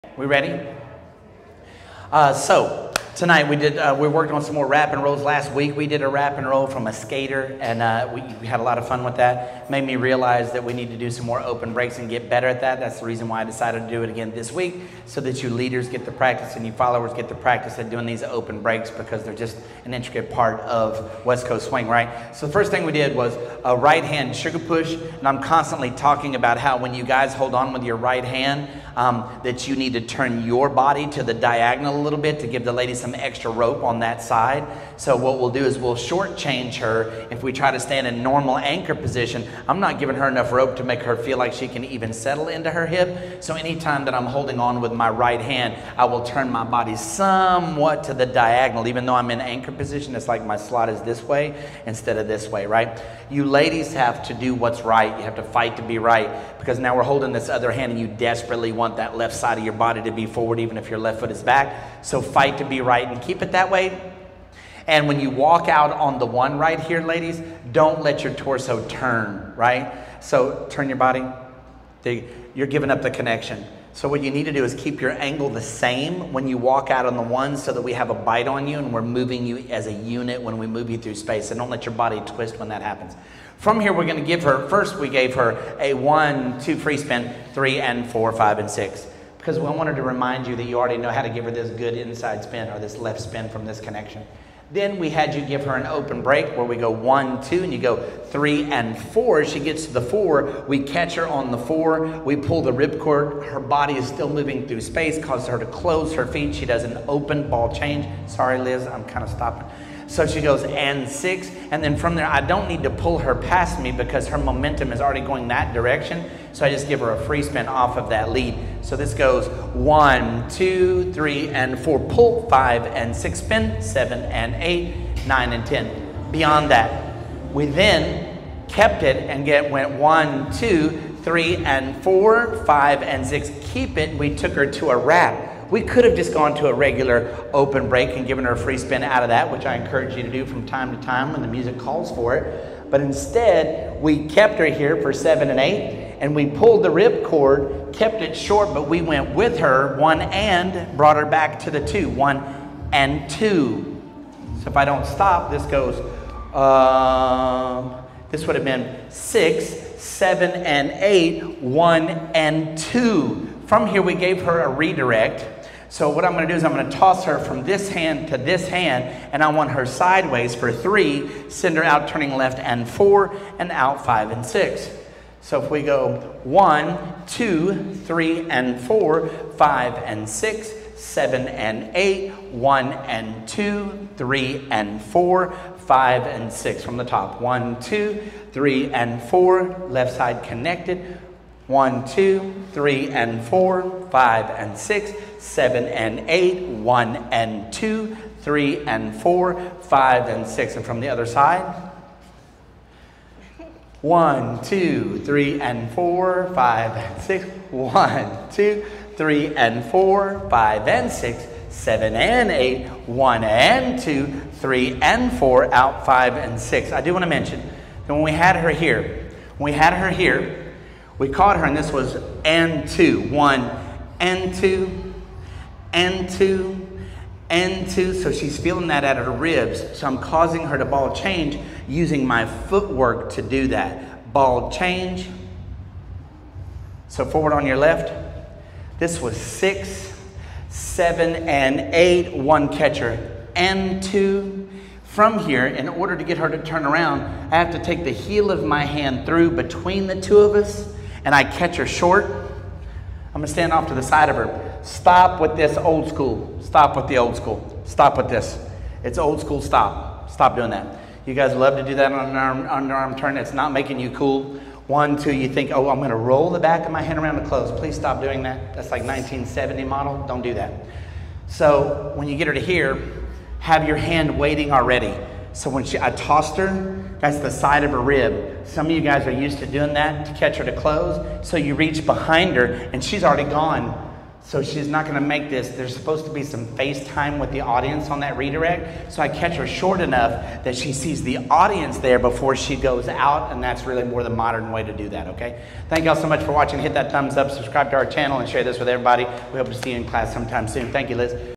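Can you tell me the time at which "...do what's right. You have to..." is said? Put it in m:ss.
0:54.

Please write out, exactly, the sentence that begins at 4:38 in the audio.
Some of you guys are used to doing that to catch her to close.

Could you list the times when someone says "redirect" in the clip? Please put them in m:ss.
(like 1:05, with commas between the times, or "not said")
2:44, 4:48.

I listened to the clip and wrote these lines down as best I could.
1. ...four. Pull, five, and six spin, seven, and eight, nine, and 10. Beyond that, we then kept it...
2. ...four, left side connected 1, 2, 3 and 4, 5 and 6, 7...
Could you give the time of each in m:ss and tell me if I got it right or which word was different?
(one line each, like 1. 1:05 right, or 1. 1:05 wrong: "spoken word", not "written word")
1. 2:01 right
2. 3:09 right.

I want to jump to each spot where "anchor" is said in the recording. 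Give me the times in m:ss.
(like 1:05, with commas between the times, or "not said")
0:38, 0:49.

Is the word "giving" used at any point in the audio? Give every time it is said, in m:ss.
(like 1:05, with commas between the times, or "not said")
0:39, 1:12.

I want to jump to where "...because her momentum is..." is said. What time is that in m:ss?
1:53.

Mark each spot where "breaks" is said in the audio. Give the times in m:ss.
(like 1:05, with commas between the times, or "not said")
0:11, 0:18, 1:36, 2:17.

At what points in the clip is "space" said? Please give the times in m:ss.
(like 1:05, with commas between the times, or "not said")
1:21, 1:44.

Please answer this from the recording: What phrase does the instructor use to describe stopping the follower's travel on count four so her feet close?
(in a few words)
pull the ripcord.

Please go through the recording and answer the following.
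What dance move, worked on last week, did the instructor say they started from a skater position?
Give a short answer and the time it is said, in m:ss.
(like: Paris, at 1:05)
wrap and roll, at 0:06.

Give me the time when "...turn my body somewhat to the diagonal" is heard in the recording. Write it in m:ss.
0:46.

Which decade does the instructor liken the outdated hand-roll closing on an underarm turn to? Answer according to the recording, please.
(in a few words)
1970.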